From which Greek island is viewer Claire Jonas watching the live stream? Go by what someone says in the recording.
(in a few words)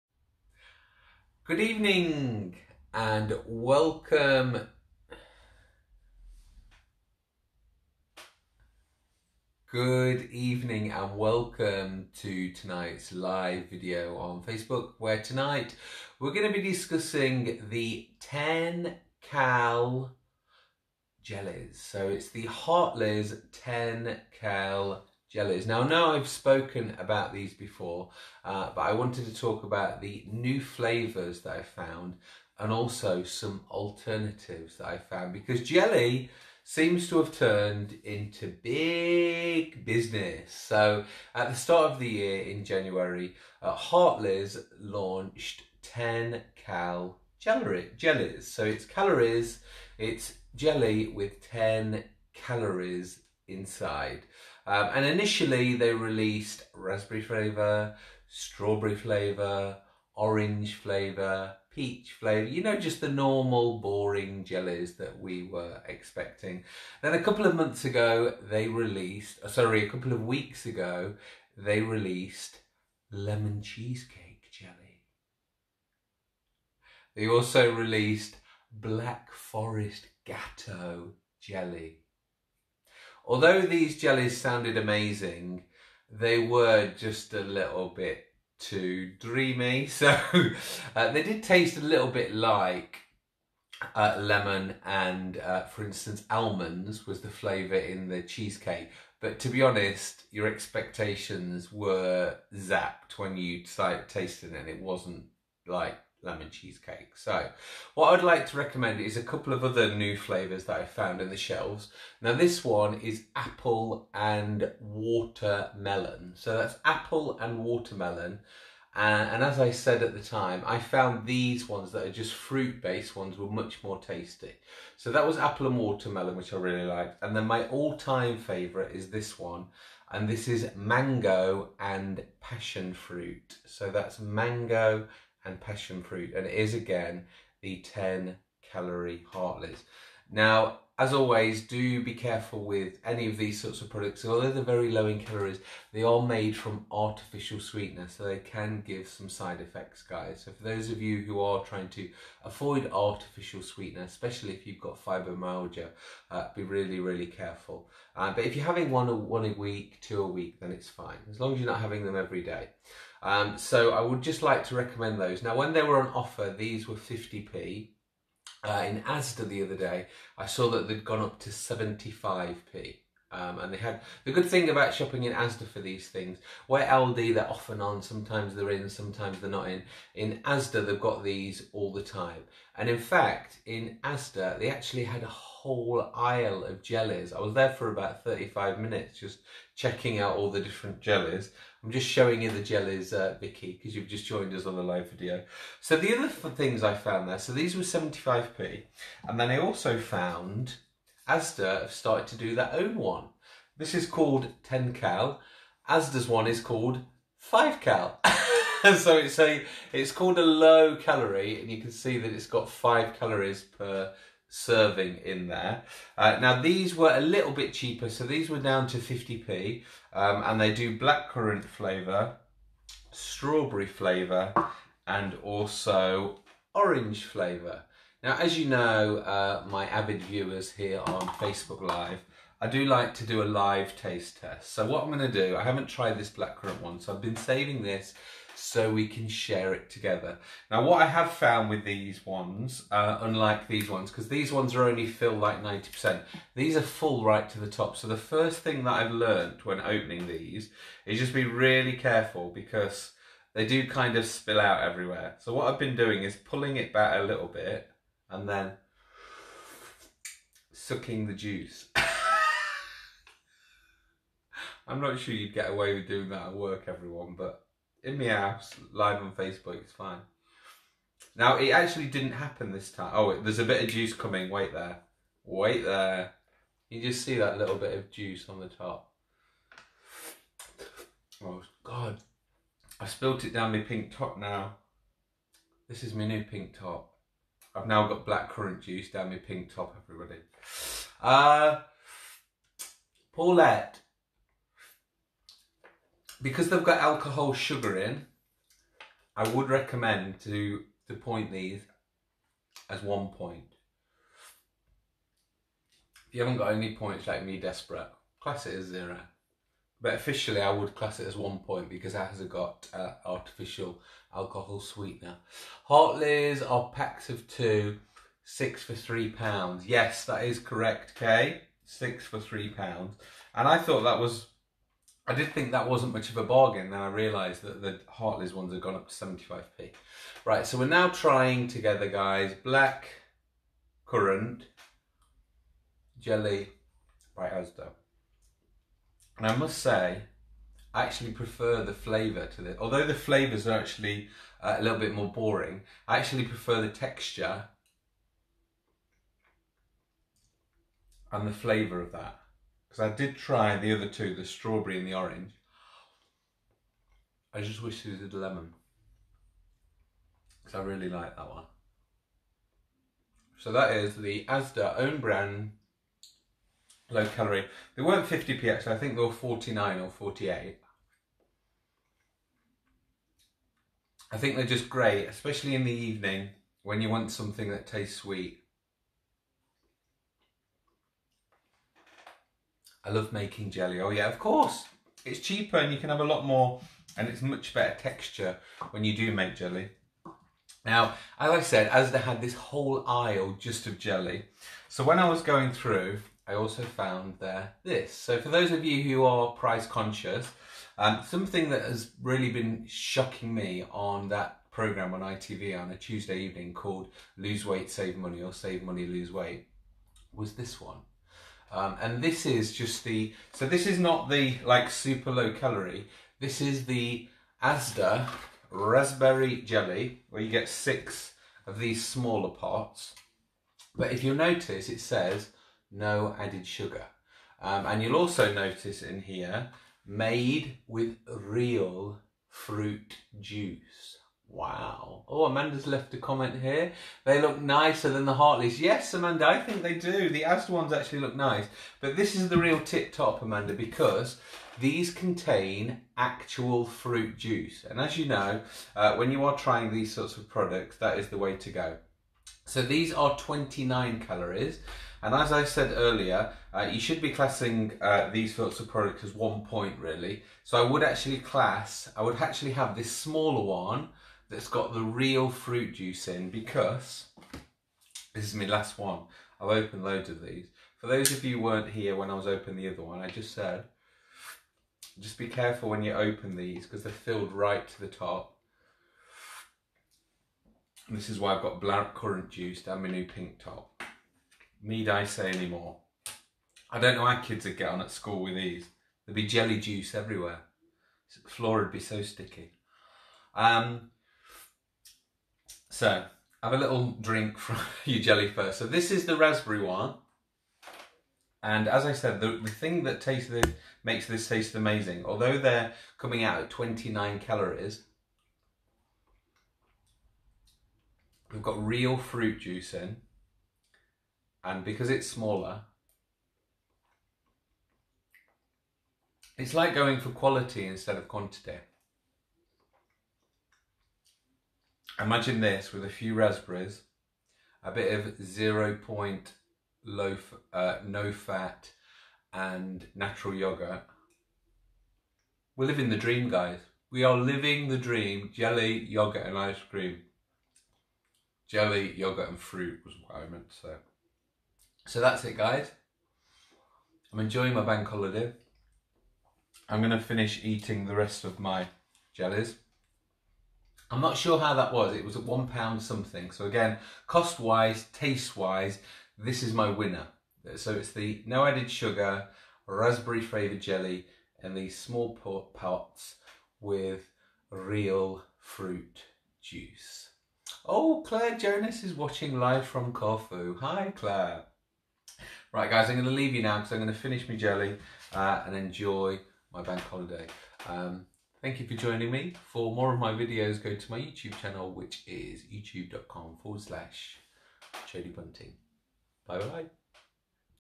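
Corfu.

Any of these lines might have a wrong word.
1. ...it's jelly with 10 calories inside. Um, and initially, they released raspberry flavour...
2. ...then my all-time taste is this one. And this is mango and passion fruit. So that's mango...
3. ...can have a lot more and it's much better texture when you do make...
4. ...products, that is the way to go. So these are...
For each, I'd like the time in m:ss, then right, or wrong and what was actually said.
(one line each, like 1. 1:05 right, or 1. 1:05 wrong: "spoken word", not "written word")
1. 0:49 right
2. 2:07 wrong: "favourite", not "taste"
3. 6:25 right
4. 7:30 right.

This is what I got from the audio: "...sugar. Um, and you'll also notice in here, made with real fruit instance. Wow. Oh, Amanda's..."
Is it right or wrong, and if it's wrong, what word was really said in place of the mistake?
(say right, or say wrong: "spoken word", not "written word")
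wrong: "juice", not "instance".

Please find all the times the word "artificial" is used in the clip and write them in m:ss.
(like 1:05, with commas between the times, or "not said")
2:26, 2:32, 5:13.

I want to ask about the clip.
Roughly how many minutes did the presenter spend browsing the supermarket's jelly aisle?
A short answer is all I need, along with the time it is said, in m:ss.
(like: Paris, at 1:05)
35, at 3:08.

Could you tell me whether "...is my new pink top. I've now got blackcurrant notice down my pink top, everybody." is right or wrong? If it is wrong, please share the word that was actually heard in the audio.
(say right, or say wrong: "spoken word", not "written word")
wrong: "juice", not "notice".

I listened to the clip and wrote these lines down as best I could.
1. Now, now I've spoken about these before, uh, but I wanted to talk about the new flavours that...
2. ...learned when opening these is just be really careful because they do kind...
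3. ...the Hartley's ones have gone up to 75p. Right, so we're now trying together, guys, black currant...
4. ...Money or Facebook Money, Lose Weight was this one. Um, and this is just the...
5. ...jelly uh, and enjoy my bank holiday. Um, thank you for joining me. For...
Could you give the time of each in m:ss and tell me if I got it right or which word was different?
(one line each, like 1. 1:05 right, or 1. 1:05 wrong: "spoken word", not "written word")
1. 0:25 right
2. 4:09 right
3. 5:27 right
4. 6:48 wrong: "Save", not "Facebook"
5. 9:37 right.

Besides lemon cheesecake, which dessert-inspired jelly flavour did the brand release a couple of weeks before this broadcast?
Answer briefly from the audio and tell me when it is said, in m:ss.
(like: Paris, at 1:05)
Black forest gateau, at 1:18.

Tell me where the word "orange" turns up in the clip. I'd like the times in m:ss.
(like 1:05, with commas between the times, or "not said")
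1:00, 3:46, 5:55.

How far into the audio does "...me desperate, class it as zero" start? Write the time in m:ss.
5:07.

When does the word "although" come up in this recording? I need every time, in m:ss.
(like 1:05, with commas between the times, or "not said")
1:23, 2:24, 5:42, 8:25.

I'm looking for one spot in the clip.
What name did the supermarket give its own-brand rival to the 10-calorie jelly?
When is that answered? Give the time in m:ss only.
3:27.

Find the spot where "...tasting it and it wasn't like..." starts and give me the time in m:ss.
1:44.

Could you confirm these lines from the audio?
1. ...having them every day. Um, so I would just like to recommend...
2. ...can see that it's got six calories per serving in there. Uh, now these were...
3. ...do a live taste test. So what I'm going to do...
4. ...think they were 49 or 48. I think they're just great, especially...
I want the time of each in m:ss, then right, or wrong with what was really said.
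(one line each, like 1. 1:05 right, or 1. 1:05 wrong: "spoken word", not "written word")
1. 2:41 right
2. 3:31 wrong: "five", not "six"
3. 3:53 right
4. 6:08 right.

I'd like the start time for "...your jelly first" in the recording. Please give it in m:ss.
8:18.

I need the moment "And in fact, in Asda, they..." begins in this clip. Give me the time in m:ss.
3:02.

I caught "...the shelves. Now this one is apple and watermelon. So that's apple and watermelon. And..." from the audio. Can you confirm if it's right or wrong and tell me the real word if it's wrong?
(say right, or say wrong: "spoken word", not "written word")
right.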